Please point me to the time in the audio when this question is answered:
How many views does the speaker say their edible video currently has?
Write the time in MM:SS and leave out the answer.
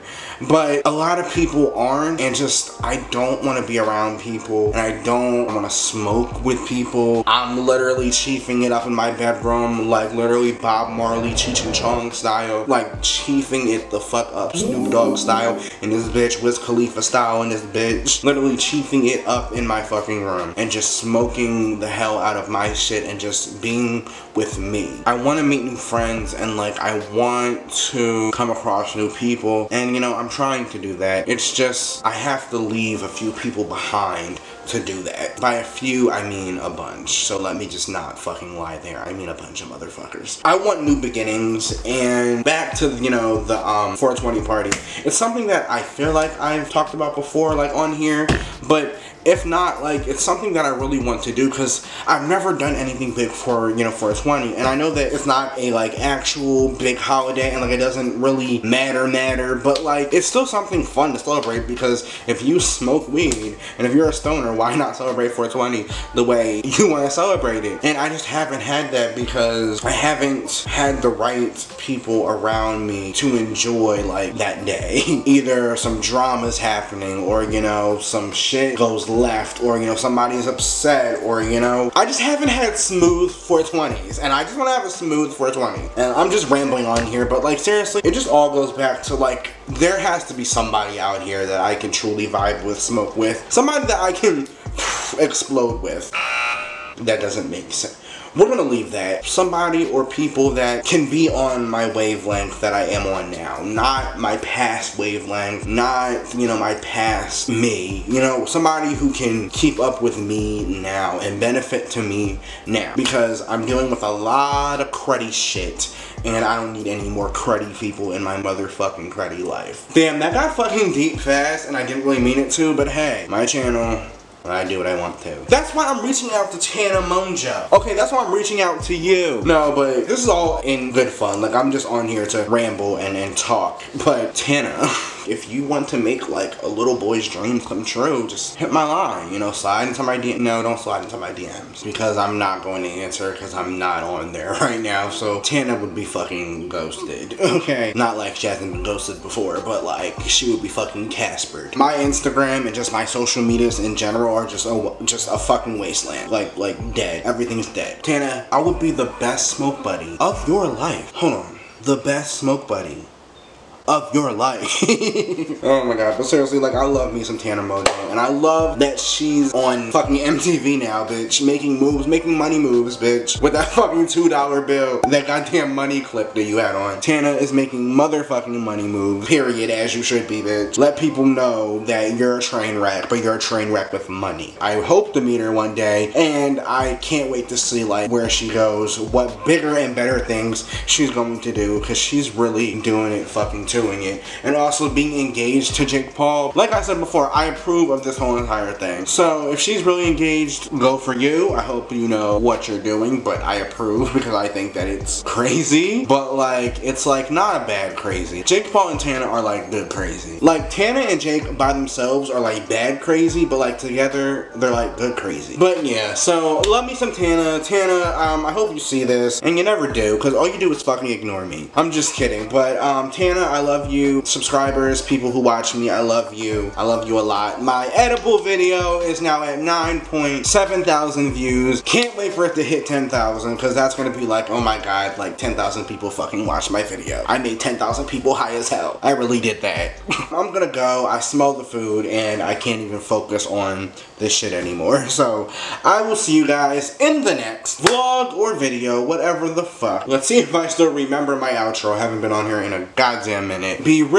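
03:49.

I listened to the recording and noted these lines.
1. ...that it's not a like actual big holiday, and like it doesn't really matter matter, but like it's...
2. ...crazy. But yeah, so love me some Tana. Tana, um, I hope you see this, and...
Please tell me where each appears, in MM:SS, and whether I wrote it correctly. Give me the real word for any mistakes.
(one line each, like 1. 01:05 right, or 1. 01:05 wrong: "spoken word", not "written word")
1. 00:54 right
2. 03:35 right.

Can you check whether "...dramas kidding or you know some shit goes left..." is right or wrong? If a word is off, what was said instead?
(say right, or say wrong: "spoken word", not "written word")
wrong: "happening", not "kidding".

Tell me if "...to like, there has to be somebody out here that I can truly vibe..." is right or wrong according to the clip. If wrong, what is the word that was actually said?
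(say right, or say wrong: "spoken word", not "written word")
right.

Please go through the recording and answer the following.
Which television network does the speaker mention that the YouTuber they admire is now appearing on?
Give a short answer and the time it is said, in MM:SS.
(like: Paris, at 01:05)
MTV, at 02:50.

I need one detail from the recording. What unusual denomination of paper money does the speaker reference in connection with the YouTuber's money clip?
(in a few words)
two dollar bill.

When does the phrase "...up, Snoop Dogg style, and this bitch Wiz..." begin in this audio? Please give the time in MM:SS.
00:14.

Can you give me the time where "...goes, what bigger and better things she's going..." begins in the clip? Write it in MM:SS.
03:08.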